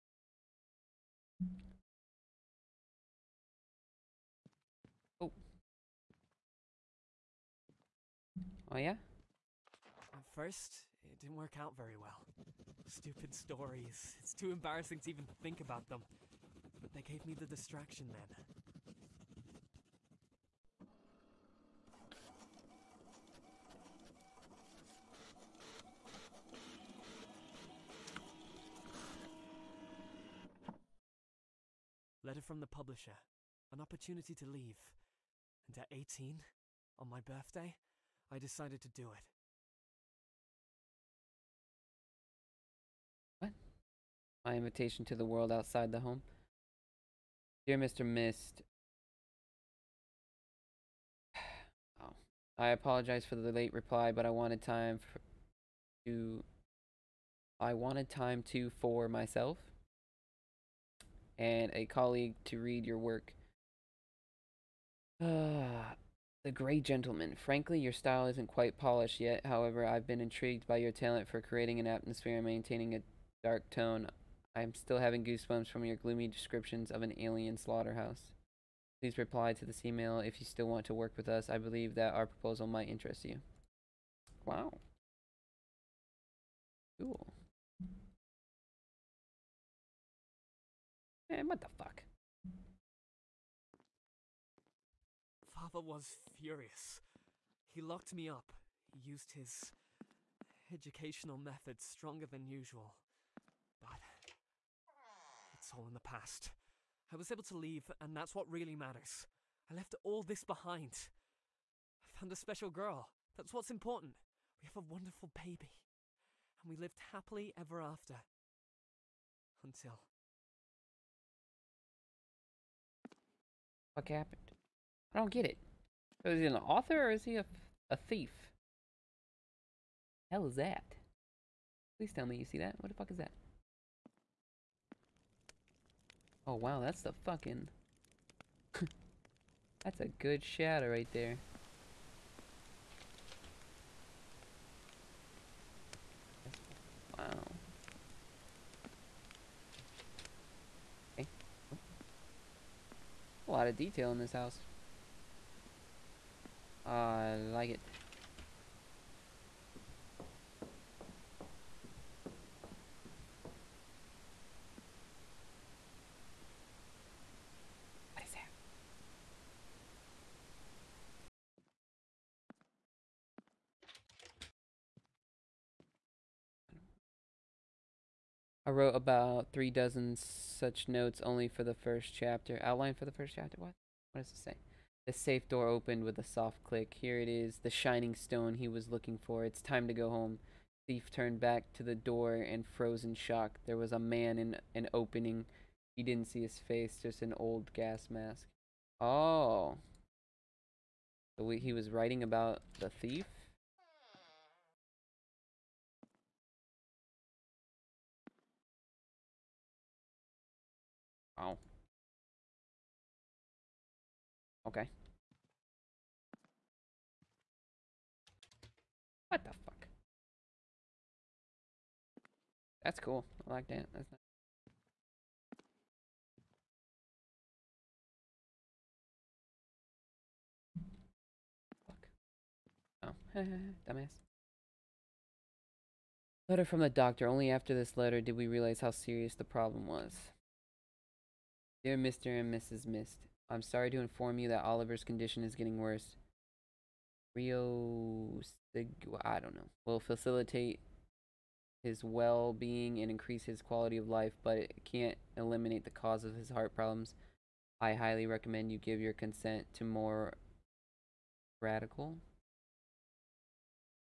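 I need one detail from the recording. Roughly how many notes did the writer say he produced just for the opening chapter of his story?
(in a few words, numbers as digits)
Three dozen.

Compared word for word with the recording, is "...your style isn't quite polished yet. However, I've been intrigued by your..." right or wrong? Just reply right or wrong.
right.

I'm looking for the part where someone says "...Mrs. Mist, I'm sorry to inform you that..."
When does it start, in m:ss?
4:02.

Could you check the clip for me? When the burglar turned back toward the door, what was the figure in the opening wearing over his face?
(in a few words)
An old gas mask.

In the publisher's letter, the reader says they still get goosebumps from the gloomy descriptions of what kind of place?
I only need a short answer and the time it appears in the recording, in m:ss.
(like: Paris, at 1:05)
An alien slaughterhouse, at 1:17.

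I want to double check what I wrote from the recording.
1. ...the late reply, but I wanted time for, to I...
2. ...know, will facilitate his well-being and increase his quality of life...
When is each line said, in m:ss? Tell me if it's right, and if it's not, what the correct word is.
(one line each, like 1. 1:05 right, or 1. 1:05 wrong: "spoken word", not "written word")
1. 0:53 right
2. 4:09 right.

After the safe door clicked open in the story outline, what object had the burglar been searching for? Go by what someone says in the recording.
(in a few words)
Shining stone.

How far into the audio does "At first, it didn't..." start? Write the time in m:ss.
0:10.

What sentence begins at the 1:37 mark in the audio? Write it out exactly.
He locked me up, he used his educational methods stronger than usual.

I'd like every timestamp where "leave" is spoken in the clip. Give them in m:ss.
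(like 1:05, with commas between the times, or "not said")
0:34, 1:47.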